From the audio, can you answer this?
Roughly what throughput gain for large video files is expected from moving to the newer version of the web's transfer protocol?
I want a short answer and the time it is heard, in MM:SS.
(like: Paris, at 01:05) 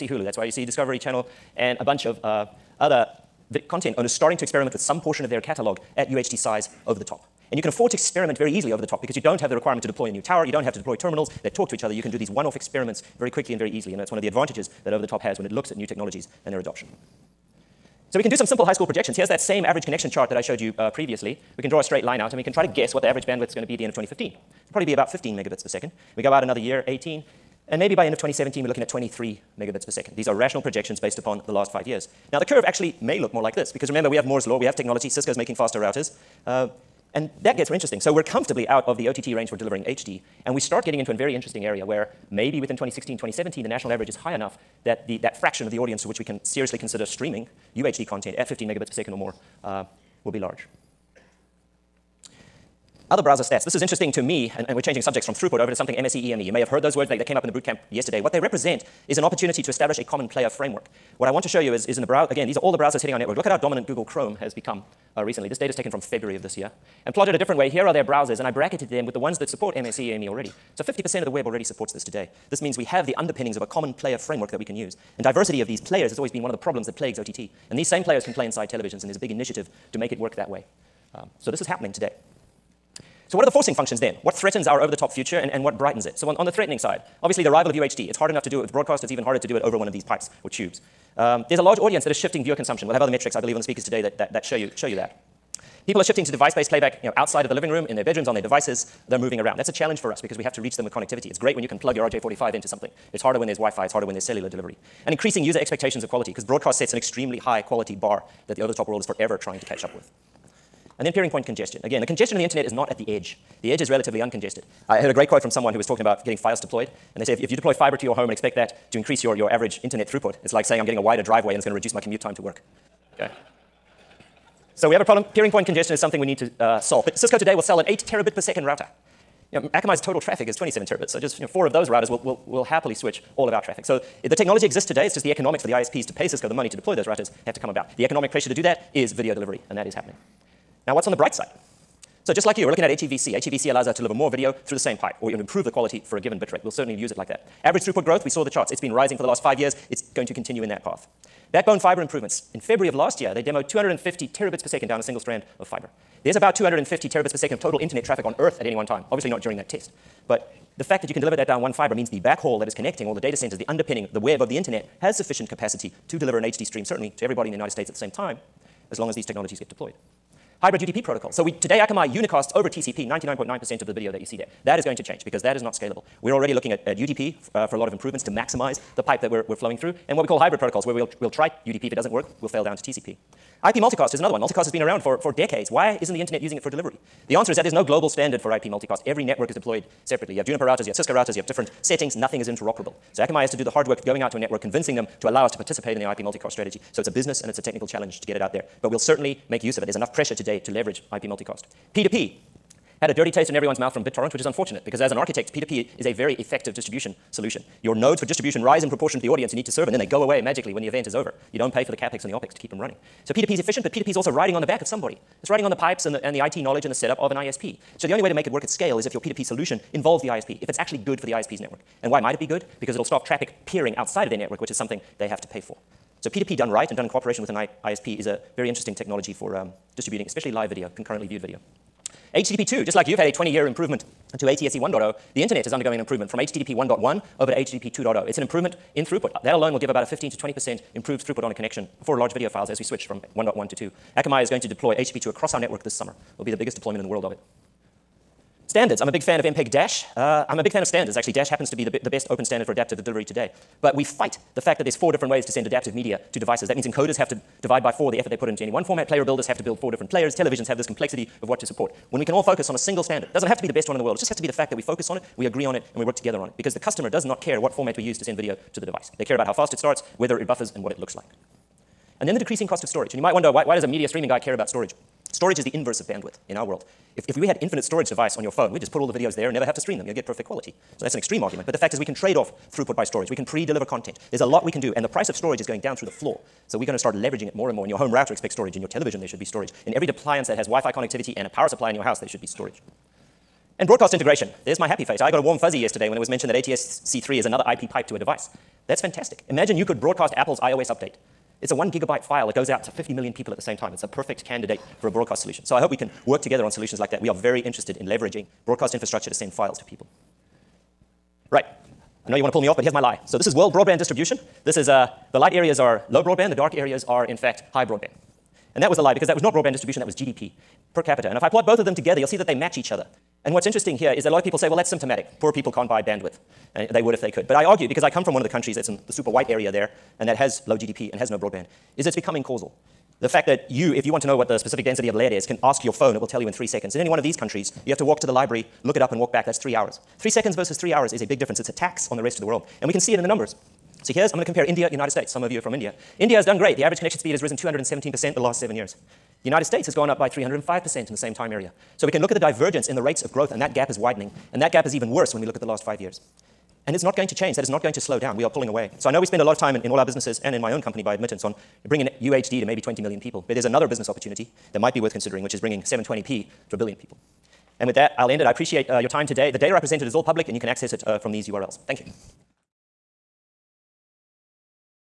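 15 to 20%, at 04:00.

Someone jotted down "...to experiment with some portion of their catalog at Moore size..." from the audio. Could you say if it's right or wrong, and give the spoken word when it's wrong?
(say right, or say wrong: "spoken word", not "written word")
wrong: "UHD", not "Moore".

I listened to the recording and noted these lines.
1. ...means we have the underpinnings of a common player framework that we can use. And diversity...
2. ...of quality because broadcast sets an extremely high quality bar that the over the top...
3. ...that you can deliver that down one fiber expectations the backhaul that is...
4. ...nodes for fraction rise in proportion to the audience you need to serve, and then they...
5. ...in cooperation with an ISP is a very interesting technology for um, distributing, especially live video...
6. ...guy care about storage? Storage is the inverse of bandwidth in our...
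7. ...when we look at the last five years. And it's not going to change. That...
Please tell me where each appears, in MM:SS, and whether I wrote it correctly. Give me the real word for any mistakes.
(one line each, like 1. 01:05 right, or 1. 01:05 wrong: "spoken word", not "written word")
1. 01:12 right
2. 01:46 right
3. 02:41 wrong: "means", not "expectations"
4. 03:27 wrong: "distribution", not "fraction"
5. 03:47 right
6. 04:34 right
7. 05:55 right.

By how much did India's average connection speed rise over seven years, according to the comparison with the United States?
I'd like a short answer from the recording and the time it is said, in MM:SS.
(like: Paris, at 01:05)
217%, at 05:47.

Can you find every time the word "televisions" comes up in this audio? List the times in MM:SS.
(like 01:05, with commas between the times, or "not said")
01:18, 04:20, 04:48.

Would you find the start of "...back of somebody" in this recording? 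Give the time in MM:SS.
03:34.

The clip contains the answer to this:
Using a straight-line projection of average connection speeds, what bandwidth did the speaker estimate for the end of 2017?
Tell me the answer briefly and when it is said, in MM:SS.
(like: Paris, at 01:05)
23 megabits per second, at 00:28.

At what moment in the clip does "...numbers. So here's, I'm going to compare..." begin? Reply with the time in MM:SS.
05:43.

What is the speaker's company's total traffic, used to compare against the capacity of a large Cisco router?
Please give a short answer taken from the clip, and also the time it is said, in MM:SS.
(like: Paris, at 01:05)
27 terabits, at 02:10.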